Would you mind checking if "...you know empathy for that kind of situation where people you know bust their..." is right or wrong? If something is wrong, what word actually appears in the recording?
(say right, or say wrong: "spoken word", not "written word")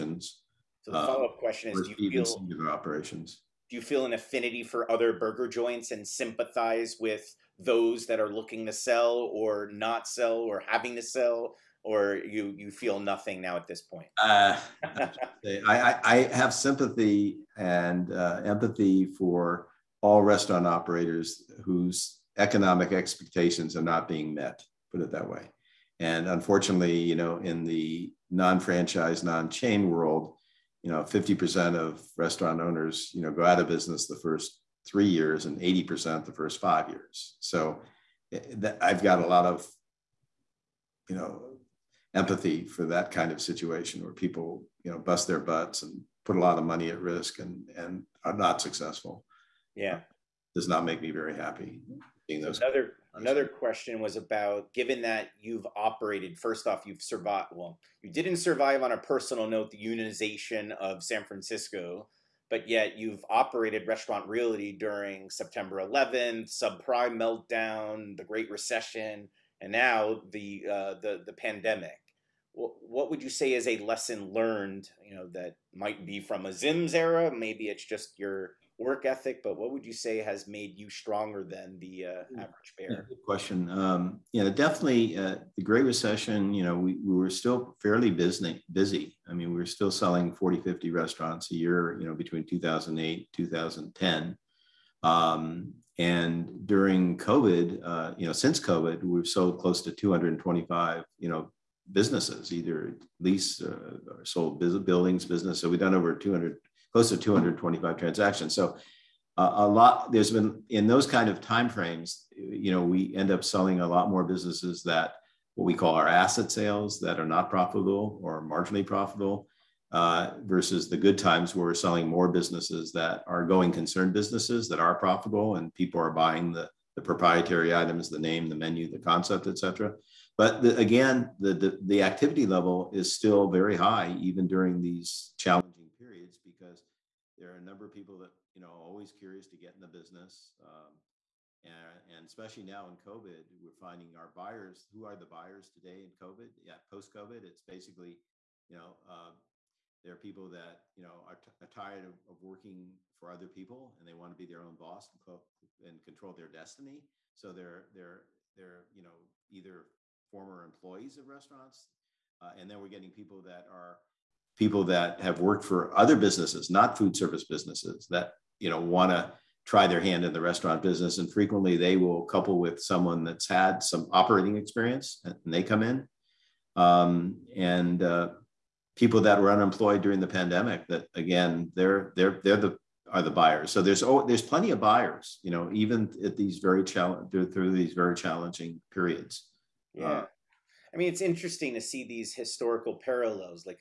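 right.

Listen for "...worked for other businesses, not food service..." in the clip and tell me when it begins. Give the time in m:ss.
2:45.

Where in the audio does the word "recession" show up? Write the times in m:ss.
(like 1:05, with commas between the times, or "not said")
1:08, 1:25.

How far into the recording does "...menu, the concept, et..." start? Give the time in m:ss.
2:08.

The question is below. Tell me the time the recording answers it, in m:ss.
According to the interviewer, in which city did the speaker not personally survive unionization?
1:01.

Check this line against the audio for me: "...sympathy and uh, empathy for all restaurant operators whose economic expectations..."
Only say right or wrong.
right.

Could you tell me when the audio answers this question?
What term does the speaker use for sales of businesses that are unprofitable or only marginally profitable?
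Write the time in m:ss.
1:56.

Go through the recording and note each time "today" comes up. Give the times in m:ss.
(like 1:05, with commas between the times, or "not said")
2:25.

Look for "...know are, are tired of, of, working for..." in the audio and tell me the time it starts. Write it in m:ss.
2:31.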